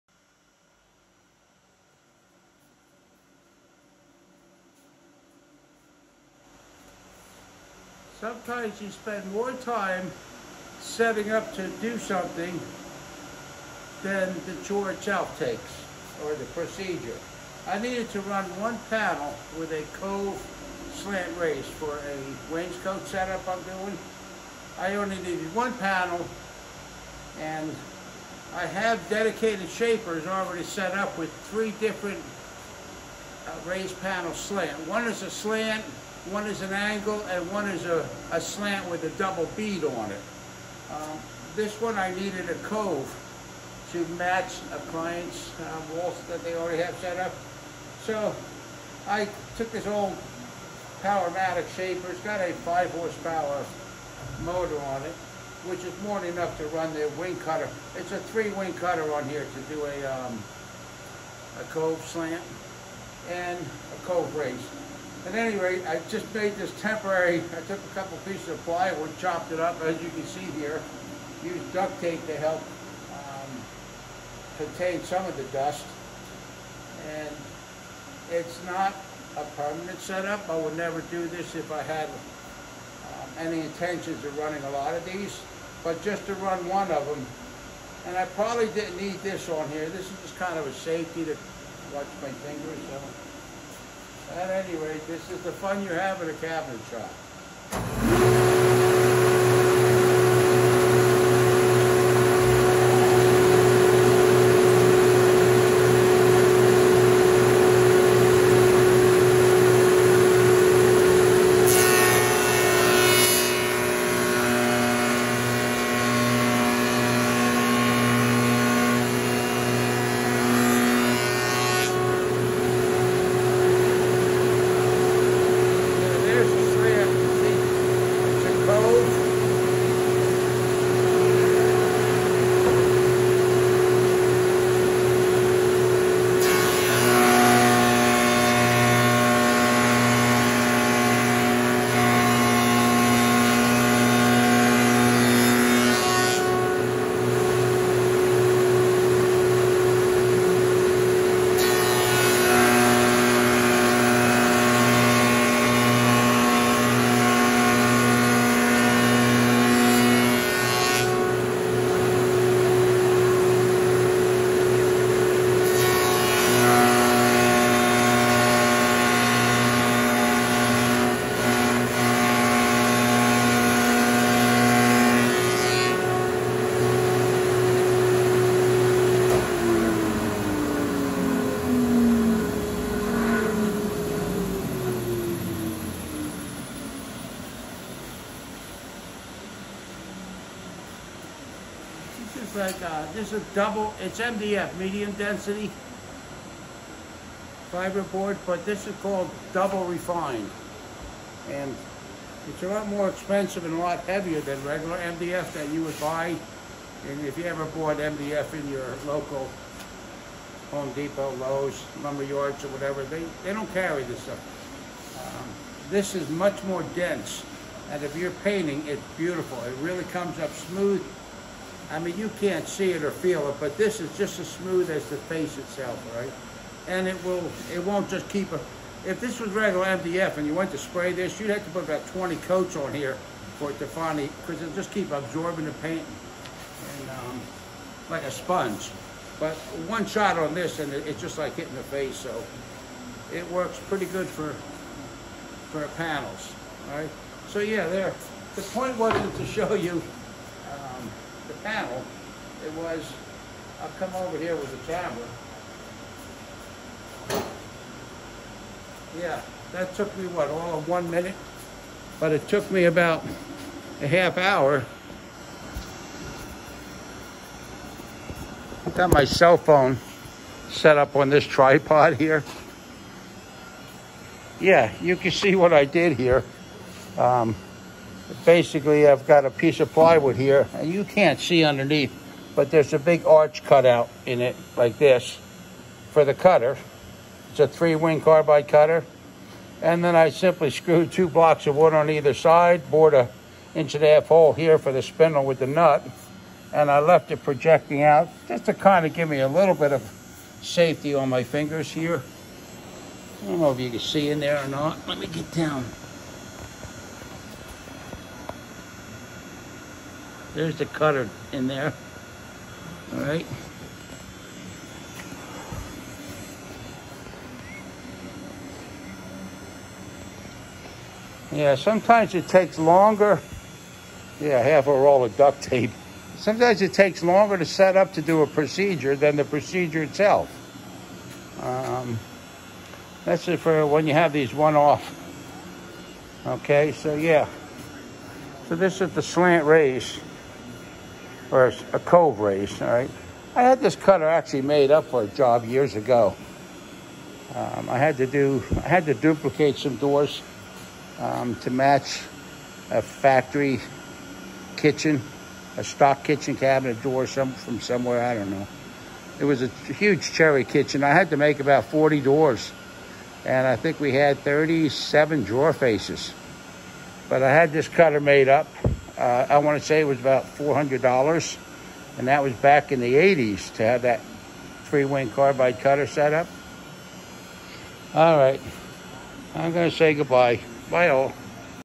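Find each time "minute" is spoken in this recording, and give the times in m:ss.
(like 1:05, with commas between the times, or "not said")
4:21.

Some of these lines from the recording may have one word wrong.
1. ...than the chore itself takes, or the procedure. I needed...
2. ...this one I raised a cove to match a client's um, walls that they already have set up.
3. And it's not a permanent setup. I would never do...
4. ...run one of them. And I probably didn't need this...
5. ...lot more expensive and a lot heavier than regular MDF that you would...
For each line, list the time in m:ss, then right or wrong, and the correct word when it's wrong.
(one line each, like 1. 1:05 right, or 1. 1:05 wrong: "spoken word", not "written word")
1. 0:14 right
2. 0:41 wrong: "needed", not "raised"
3. 1:17 right
4. 1:26 right
5. 3:22 right.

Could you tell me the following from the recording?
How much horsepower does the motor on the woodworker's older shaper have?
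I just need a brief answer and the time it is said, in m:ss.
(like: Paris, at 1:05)
5, at 0:52.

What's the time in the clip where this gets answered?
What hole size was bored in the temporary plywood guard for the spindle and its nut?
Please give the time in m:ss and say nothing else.
4:53.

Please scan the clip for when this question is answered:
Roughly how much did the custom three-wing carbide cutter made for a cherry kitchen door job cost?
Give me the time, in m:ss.
6:10.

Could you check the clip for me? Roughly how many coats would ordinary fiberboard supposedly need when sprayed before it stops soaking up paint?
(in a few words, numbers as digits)
20.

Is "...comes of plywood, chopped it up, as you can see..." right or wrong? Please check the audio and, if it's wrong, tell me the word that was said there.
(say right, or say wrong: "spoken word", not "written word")
wrong: "pieces", not "comes".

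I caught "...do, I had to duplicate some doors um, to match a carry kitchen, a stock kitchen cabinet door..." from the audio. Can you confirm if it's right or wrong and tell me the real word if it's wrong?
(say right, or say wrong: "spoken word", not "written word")
wrong: "factory", not "carry".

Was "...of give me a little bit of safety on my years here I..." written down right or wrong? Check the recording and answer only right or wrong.
wrong.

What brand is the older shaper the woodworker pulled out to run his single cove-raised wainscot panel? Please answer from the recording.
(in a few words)
Powermatic.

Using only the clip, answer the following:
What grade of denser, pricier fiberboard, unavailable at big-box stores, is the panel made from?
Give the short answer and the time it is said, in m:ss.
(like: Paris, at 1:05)
double refined, at 3:19.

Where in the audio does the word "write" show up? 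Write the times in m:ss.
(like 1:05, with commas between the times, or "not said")
not said.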